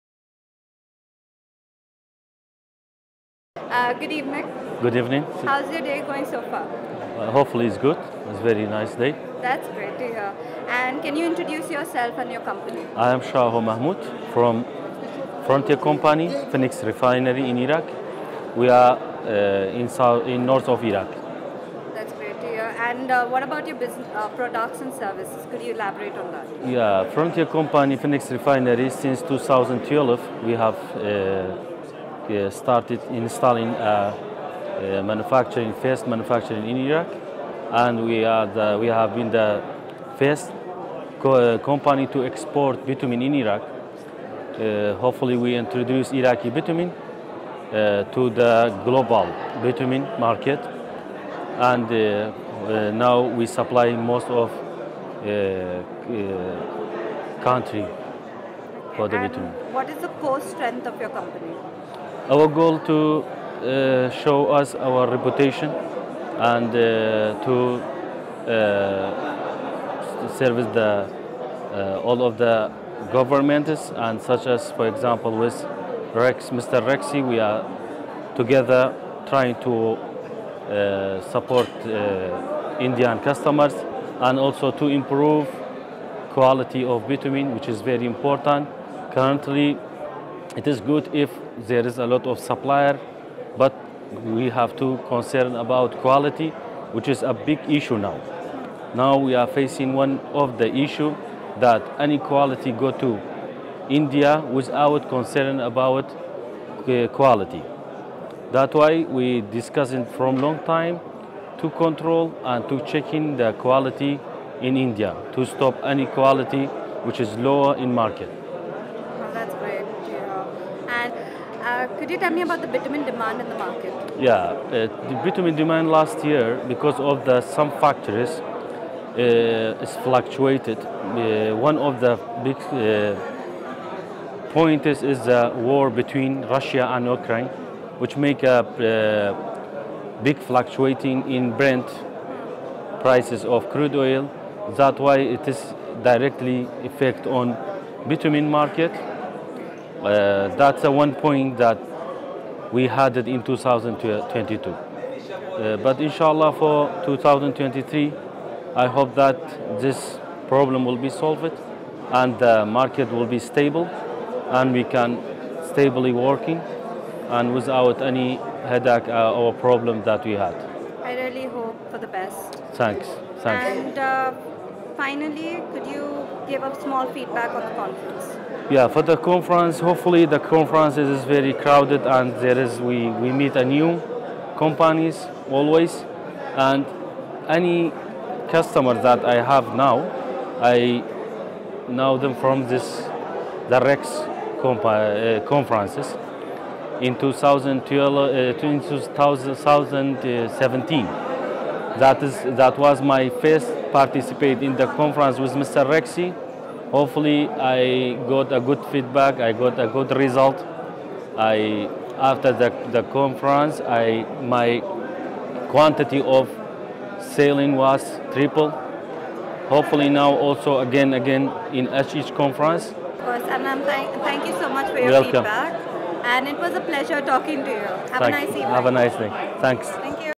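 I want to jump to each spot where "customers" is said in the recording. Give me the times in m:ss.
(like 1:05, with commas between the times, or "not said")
1:23, 3:08.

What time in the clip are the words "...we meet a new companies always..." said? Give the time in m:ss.
3:03.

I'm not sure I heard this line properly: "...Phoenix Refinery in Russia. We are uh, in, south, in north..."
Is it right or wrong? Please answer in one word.
wrong.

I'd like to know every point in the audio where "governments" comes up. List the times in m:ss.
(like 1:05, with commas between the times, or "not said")
1:13.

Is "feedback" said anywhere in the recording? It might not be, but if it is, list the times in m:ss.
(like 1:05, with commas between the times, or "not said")
2:57, 3:28, 3:45.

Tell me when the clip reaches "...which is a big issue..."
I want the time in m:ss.
1:36.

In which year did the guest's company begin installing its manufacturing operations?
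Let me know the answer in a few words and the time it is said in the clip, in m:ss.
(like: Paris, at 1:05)
2012, at 0:28.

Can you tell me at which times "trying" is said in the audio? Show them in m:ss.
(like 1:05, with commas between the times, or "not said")
1:19.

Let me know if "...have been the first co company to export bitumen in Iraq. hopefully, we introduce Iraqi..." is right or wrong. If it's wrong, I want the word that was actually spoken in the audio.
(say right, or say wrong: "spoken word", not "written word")
right.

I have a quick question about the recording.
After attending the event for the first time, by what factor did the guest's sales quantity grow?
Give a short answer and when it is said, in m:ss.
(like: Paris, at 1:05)
Triple, at 3:38.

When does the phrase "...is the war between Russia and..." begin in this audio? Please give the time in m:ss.
2:15.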